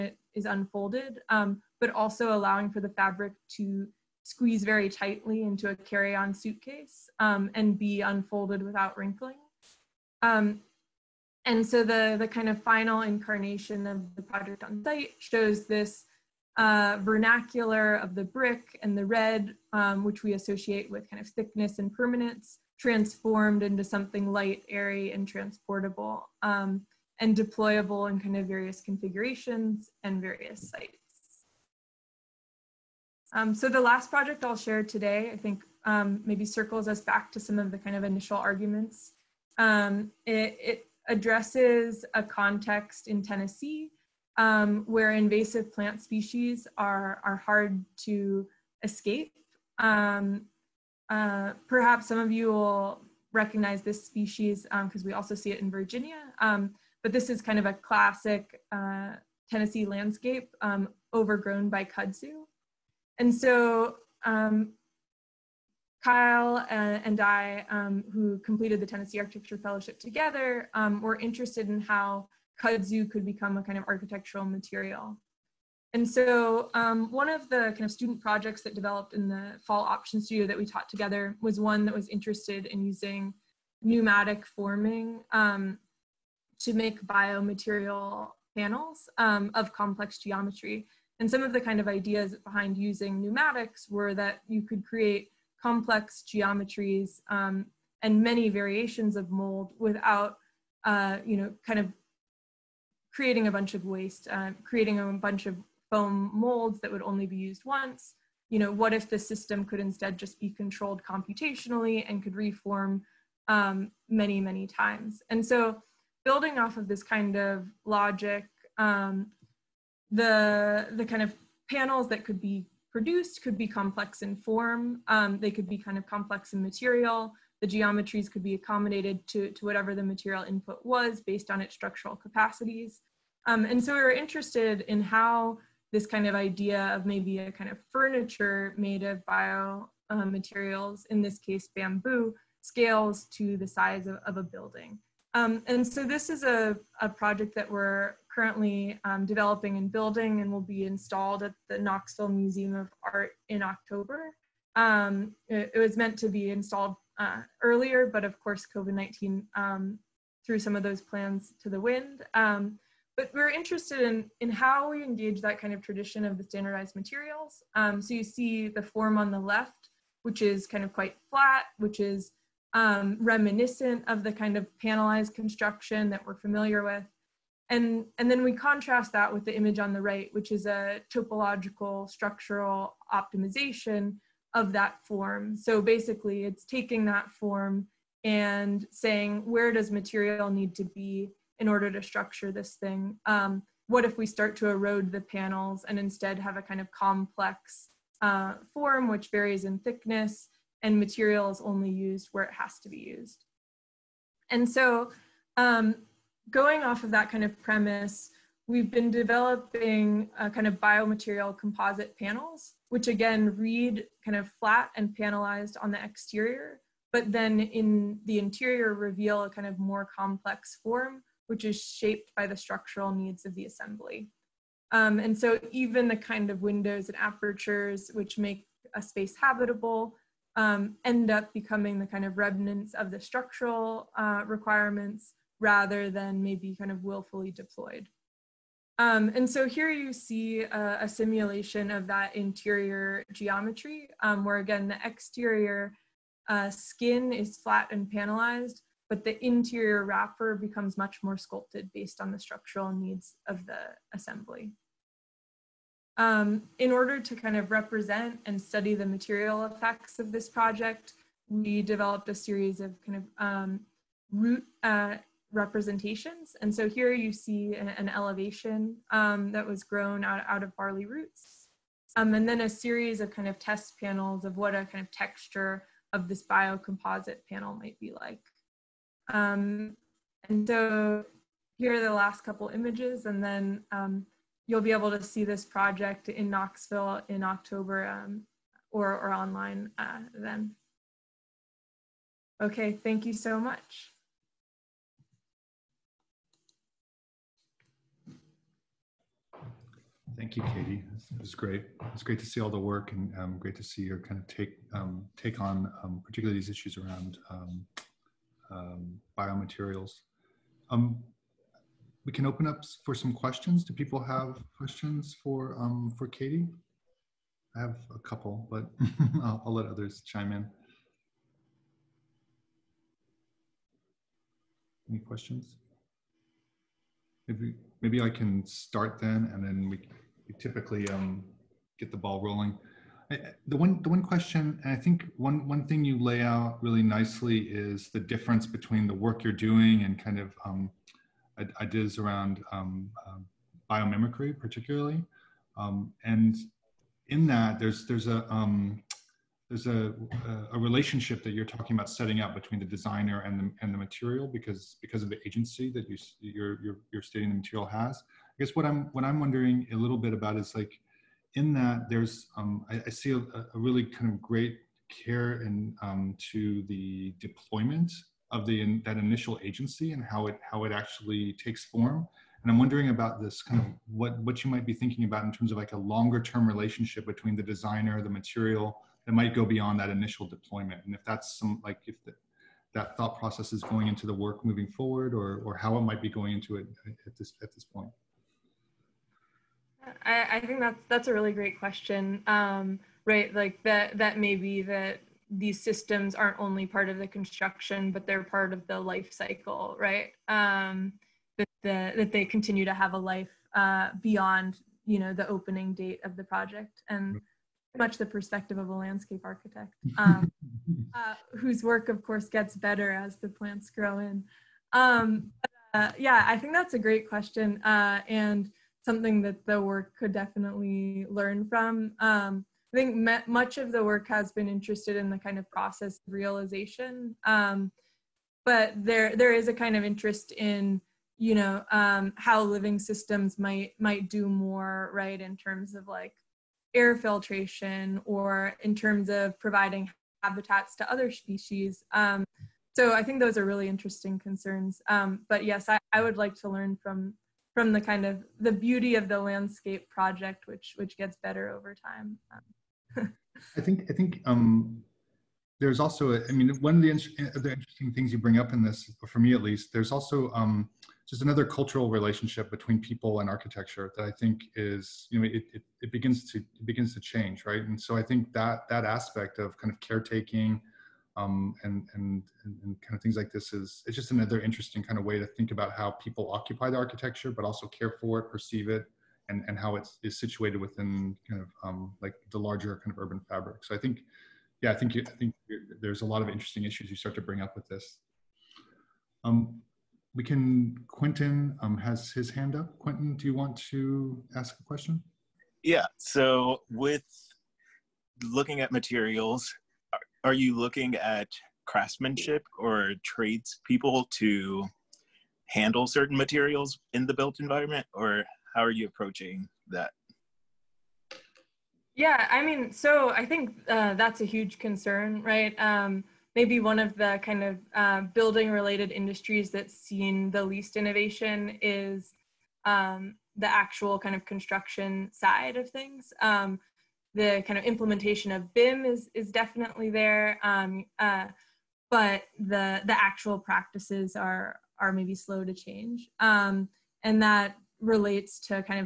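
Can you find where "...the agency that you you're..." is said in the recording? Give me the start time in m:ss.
5:55.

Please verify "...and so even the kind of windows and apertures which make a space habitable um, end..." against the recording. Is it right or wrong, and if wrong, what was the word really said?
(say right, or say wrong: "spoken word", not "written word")
right.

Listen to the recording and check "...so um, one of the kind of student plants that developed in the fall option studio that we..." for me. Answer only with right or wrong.
wrong.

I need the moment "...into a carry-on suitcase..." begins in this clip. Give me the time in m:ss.
0:05.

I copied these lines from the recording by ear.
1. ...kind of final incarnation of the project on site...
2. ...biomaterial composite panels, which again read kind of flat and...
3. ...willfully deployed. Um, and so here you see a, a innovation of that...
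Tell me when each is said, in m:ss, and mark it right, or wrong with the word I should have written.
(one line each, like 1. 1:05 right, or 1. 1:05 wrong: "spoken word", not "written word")
1. 0:12 right
2. 3:30 right
3. 3:57 wrong: "simulation", not "innovation".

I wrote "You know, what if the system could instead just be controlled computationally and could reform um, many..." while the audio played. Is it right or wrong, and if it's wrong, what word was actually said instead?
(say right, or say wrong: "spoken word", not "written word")
right.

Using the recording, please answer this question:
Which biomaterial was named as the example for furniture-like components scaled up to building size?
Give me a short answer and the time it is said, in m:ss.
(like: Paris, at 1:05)
bamboo, at 2:21.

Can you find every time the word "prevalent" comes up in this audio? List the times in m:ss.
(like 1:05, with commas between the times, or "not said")
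not said.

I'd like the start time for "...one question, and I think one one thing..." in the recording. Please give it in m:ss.
5:34.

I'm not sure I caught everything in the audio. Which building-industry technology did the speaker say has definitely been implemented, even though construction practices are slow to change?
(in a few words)
BIM.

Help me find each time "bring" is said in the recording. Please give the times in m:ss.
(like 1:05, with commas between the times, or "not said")
7:38, 8:07.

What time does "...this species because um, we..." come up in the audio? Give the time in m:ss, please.
0:53.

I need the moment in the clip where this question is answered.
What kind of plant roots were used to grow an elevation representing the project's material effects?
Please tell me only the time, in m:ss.
4:30.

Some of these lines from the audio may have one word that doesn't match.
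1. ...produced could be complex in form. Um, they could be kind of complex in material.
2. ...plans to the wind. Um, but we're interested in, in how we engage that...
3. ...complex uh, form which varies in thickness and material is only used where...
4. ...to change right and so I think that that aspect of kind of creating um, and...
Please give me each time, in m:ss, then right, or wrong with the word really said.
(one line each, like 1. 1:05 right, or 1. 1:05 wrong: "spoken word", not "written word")
1. 2:02 right
2. 2:41 right
3. 3:16 right
4. 7:47 wrong: "caretaking", not "creating".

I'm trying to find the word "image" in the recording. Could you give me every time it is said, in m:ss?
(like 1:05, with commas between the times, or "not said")
2:59, 4:42.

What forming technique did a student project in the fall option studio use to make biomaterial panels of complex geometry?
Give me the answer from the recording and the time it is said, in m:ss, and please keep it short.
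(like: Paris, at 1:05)
pneumatic forming, at 1:23.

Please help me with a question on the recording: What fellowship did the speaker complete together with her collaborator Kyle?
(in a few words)
Tennessee Architecture Fellowship.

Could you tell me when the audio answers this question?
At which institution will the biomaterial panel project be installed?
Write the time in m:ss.
2:31.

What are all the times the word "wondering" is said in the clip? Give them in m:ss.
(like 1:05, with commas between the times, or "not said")
5:59, 6:12.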